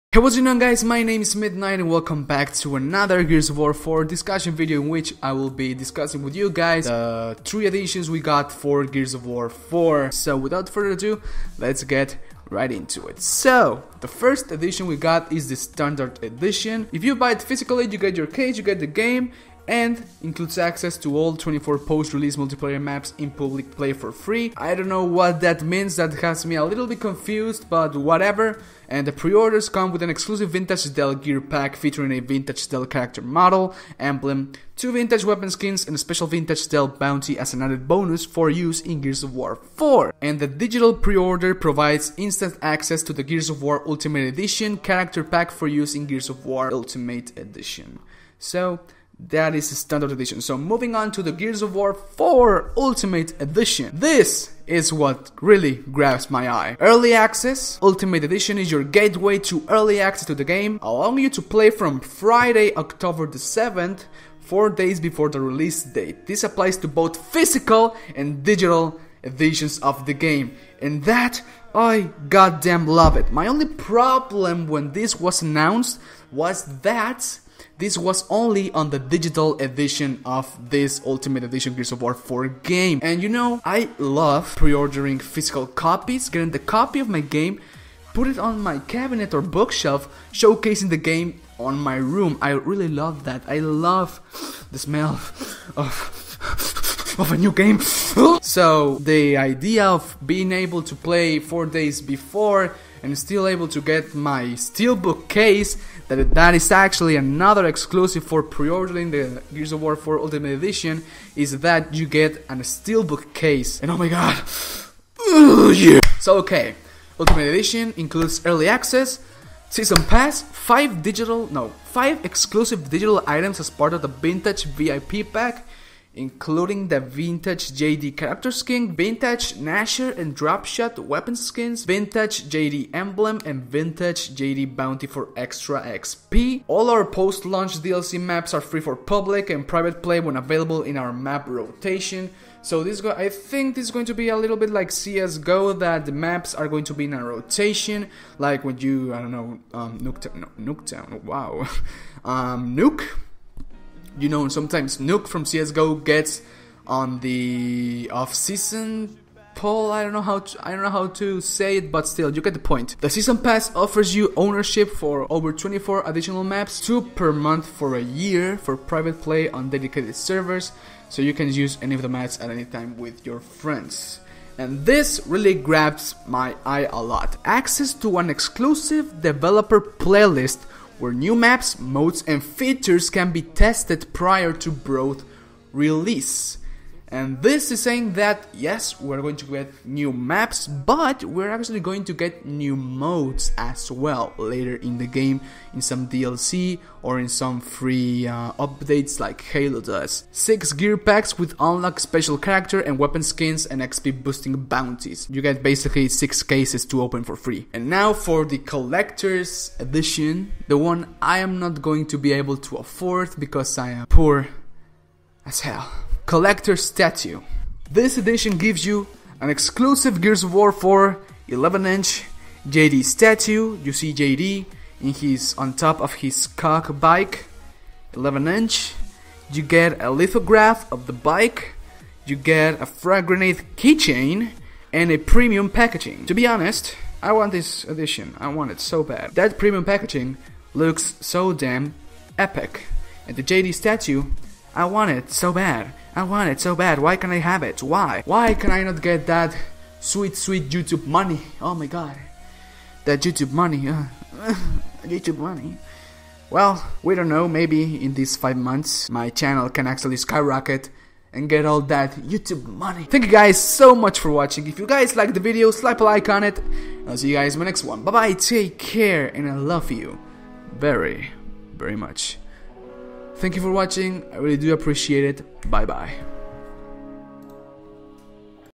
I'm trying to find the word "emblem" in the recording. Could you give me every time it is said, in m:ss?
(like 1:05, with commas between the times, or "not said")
0:33, 2:12.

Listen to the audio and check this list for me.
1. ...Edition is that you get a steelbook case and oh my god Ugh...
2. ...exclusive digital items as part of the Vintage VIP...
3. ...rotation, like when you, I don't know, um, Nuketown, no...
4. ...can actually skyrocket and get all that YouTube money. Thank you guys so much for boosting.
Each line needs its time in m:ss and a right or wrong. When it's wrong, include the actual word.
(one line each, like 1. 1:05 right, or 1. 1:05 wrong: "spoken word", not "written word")
1. 1:50 right
2. 2:02 right
3. 2:27 right
4. 4:19 wrong: "watching", not "boosting".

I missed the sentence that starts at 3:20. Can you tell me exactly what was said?
6 gear packs with unlock special character and weapon skins and XP boosting bounties.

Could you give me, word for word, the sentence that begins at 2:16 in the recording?
All our post-launch DLC maps are free for public and private play when available in our map rotation.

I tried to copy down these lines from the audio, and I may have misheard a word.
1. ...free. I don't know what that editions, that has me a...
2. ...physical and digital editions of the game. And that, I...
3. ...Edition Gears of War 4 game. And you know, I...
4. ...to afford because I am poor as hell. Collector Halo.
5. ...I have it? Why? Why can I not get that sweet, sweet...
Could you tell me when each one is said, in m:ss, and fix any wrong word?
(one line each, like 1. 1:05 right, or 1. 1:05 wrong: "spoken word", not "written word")
1. 0:24 wrong: "means", not "editions"
2. 1:07 right
3. 1:21 right
4. 3:32 wrong: "Statue", not "Halo"
5. 4:07 right.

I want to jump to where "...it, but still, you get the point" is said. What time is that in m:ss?
2:41.